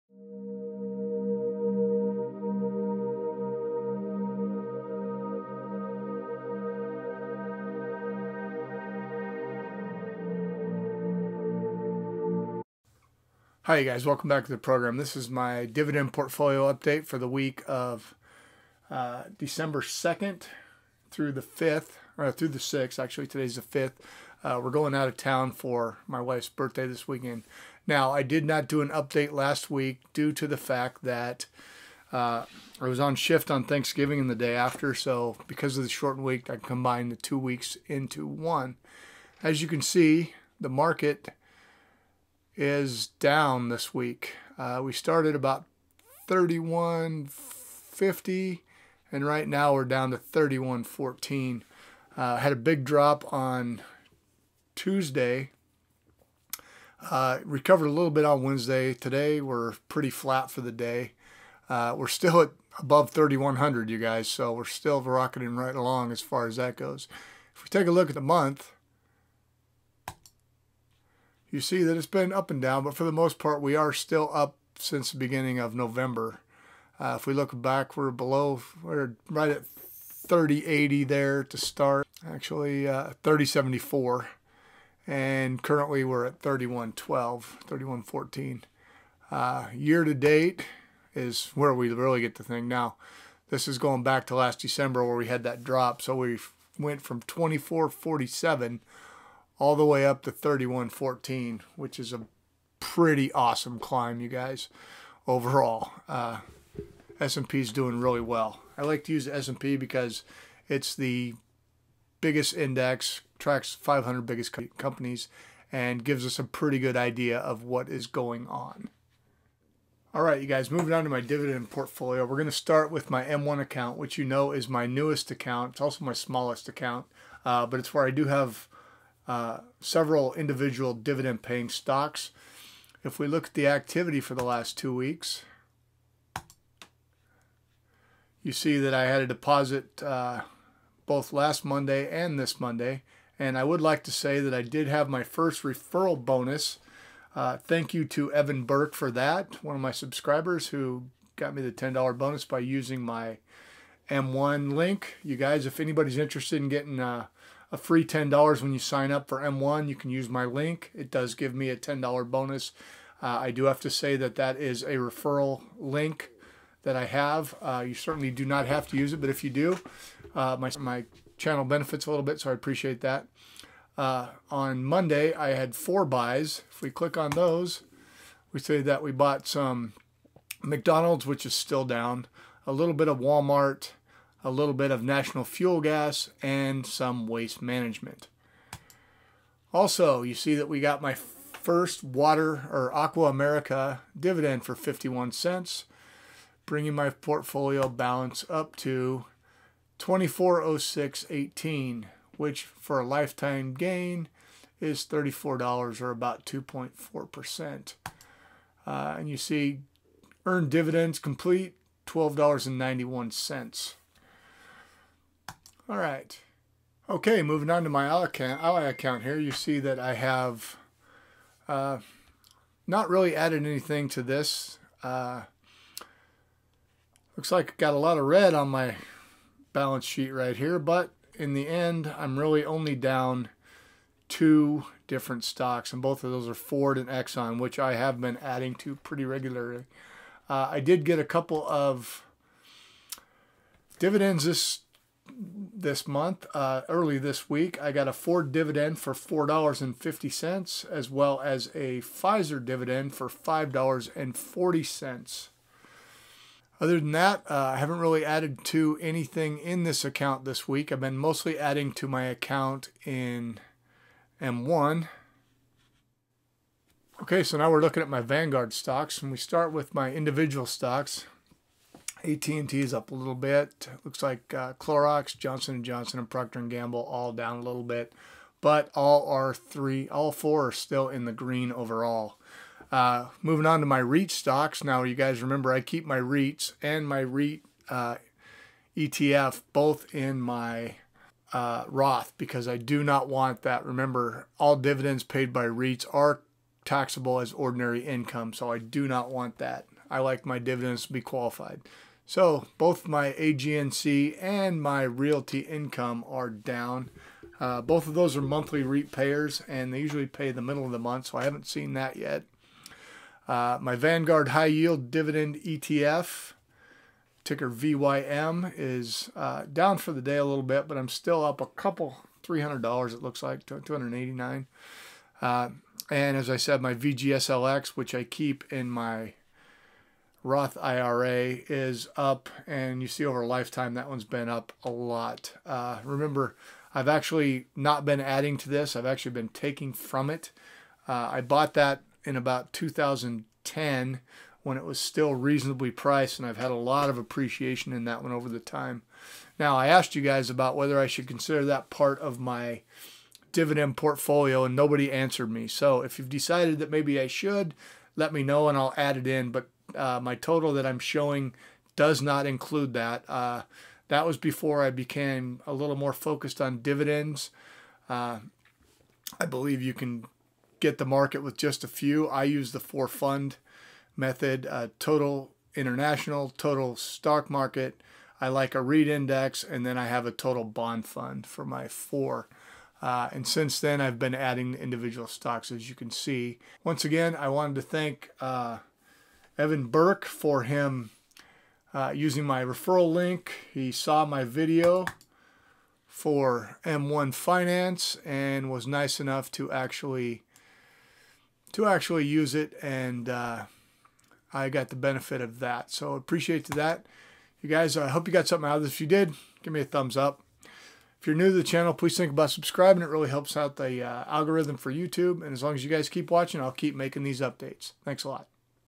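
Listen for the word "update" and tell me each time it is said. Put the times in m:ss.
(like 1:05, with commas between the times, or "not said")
0:16, 0:28, 6:57.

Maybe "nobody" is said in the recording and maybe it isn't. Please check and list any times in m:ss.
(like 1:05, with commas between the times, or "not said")
5:54.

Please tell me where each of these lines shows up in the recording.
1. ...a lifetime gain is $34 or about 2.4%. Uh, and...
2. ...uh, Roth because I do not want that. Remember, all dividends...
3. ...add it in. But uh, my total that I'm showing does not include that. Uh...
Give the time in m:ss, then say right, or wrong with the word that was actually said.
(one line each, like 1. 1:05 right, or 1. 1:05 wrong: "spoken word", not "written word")
1. 3:22 right
2. 4:51 right
3. 5:58 right.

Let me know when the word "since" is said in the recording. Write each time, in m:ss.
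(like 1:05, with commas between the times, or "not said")
1:14, 6:23.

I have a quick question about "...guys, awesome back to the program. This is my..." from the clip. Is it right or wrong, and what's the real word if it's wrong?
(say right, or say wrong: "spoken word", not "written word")
wrong: "welcome", not "awesome".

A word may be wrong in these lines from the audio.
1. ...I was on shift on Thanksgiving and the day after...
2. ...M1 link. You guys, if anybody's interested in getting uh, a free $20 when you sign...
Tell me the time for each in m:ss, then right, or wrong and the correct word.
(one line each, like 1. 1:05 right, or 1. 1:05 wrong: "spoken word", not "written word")
1. 0:32 right
2. 2:34 wrong: "10", not "20".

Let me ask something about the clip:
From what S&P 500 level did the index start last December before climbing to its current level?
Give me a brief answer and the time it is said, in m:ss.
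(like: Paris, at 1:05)
2447, at 1:37.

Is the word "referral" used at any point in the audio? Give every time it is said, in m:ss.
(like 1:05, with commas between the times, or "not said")
2:25, 2:44, 6:32.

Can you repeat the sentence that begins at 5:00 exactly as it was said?
I like my dividends to be qualified.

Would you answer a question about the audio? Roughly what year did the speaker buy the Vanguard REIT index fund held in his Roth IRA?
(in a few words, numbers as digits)
2010.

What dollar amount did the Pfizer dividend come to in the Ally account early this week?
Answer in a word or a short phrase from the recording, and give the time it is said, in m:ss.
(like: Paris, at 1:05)
$5.40, at 4:13.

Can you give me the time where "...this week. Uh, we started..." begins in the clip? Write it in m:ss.
0:43.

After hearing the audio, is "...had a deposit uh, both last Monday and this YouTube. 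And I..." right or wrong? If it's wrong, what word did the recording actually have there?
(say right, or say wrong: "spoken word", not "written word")
wrong: "Monday", not "YouTube".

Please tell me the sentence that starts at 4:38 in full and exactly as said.
But all are three, all four are still in the green overall.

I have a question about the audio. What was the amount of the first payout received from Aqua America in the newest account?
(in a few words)
51 cents.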